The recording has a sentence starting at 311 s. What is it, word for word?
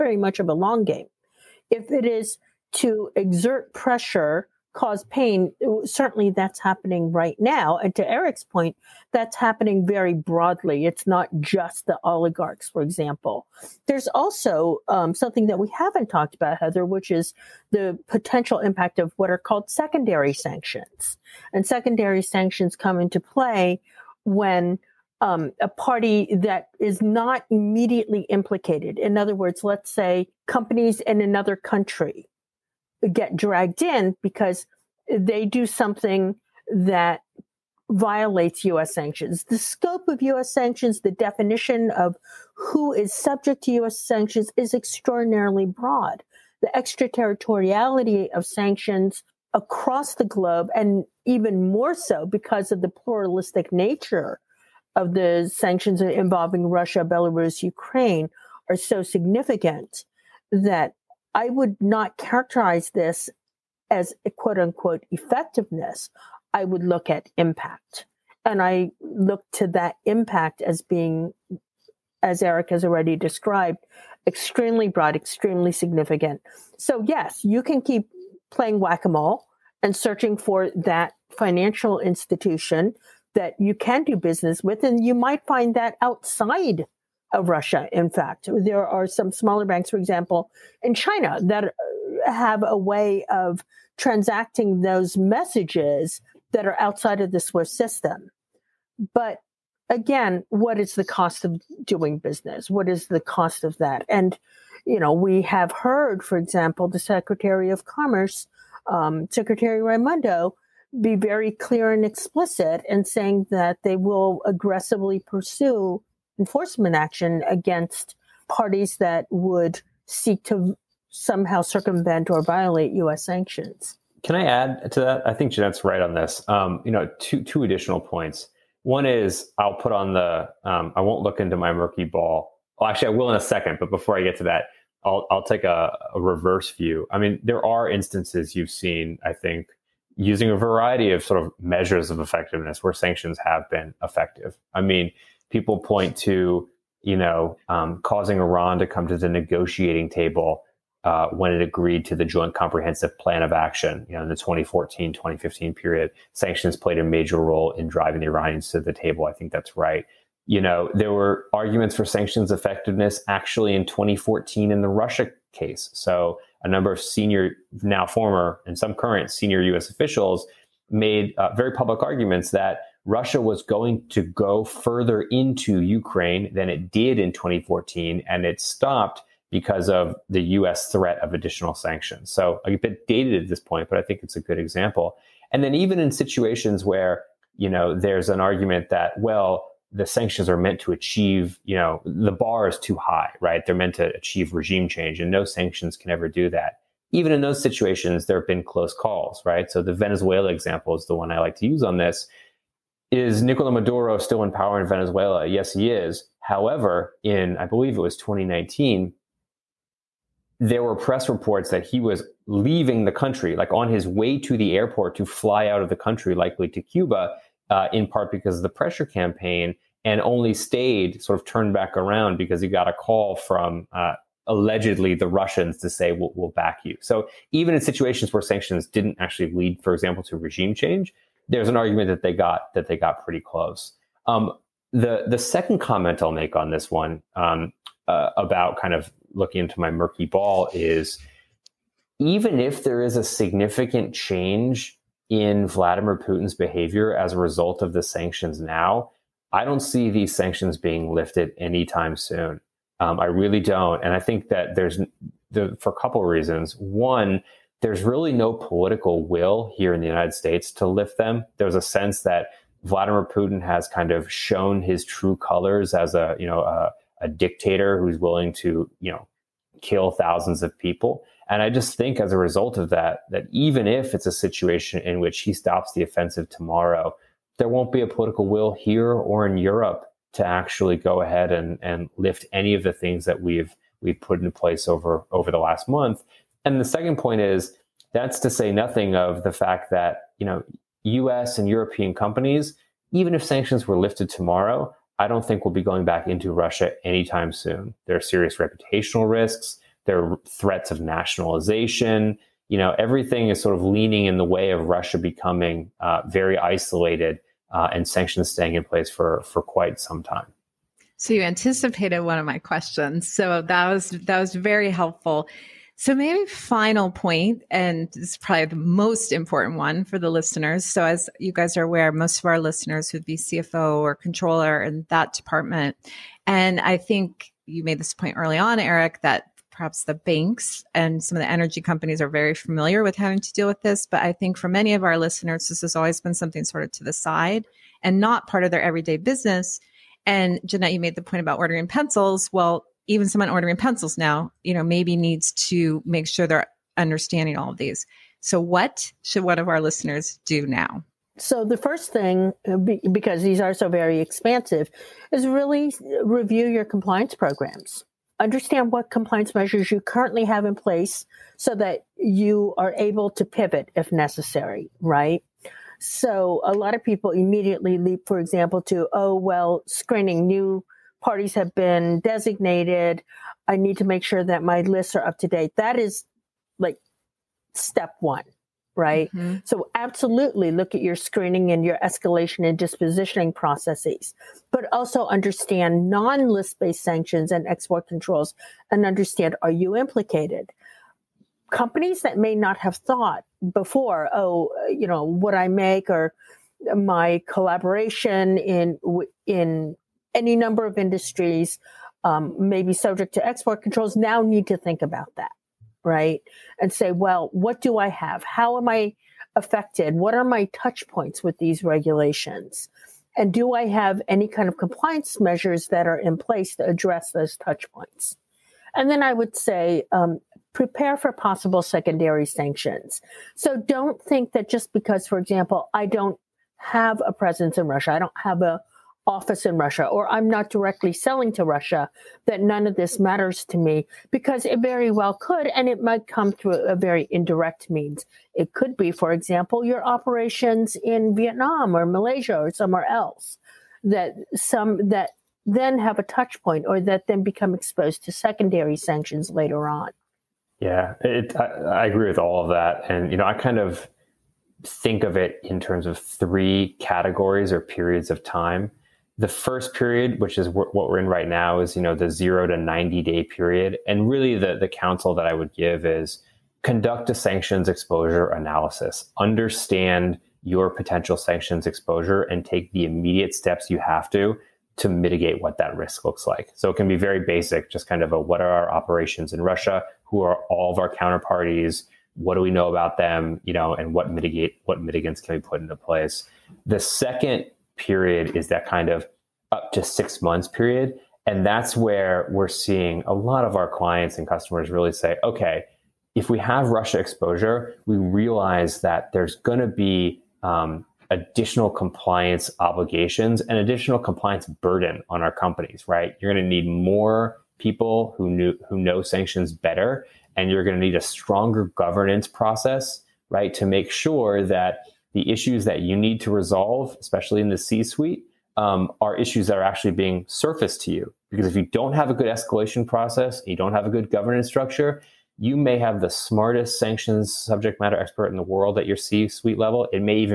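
So you anticipated one of my questions.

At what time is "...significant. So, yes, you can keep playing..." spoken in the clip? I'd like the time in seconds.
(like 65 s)
75 s.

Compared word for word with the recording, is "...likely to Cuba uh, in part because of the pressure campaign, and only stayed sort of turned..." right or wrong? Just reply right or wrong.
right.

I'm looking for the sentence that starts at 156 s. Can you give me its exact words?
Sanctions played a major role in driving the Iranians to the table.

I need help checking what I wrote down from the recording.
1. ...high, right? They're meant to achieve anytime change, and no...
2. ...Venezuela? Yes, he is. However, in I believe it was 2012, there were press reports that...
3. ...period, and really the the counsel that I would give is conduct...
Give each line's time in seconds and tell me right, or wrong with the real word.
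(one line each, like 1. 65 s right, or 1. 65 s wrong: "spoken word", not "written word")
1. 192 s wrong: "regime", not "anytime"
2. 204 s wrong: "2019", not "2012"
3. 463 s right.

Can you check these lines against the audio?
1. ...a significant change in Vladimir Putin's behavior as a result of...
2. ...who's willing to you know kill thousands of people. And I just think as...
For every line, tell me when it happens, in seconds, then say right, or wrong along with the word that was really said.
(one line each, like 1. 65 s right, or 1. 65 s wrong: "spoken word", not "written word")
1. 243 s right
2. 267 s right.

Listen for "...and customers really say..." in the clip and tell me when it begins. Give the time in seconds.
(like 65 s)
494 s.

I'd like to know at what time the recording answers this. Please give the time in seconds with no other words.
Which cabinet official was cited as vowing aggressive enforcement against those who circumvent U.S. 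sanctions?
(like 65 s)
109 s.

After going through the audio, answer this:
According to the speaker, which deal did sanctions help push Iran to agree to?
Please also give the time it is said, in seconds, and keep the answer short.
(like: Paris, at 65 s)
Joint Comprehensive Plan of Action, at 152 s.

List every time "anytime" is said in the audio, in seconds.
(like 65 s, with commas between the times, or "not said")
251 s, 297 s.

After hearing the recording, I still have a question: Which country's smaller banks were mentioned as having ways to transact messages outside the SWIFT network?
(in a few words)
China.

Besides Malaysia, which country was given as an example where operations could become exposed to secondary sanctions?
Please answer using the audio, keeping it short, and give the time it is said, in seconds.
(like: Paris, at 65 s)
Vietnam, at 441 s.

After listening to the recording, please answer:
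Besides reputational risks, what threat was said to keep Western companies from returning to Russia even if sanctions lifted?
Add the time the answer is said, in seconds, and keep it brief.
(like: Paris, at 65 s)
nationalization, at 301 s.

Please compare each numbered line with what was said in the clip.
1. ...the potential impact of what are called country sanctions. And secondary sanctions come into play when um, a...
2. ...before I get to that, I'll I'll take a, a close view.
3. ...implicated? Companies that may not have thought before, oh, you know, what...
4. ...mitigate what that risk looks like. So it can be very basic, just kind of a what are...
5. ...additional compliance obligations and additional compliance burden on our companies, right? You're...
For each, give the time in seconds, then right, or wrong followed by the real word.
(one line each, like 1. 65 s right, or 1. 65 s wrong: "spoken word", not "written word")
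1. 17 s wrong: "secondary", not "country"
2. 133 s wrong: "reverse", not "close"
3. 389 s right
4. 475 s right
5. 501 s right.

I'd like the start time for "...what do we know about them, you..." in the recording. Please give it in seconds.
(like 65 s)
482 s.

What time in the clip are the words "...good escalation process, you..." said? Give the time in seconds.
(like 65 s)
522 s.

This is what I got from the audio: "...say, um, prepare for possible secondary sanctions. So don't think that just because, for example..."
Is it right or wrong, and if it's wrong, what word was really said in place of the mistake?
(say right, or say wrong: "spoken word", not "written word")
right.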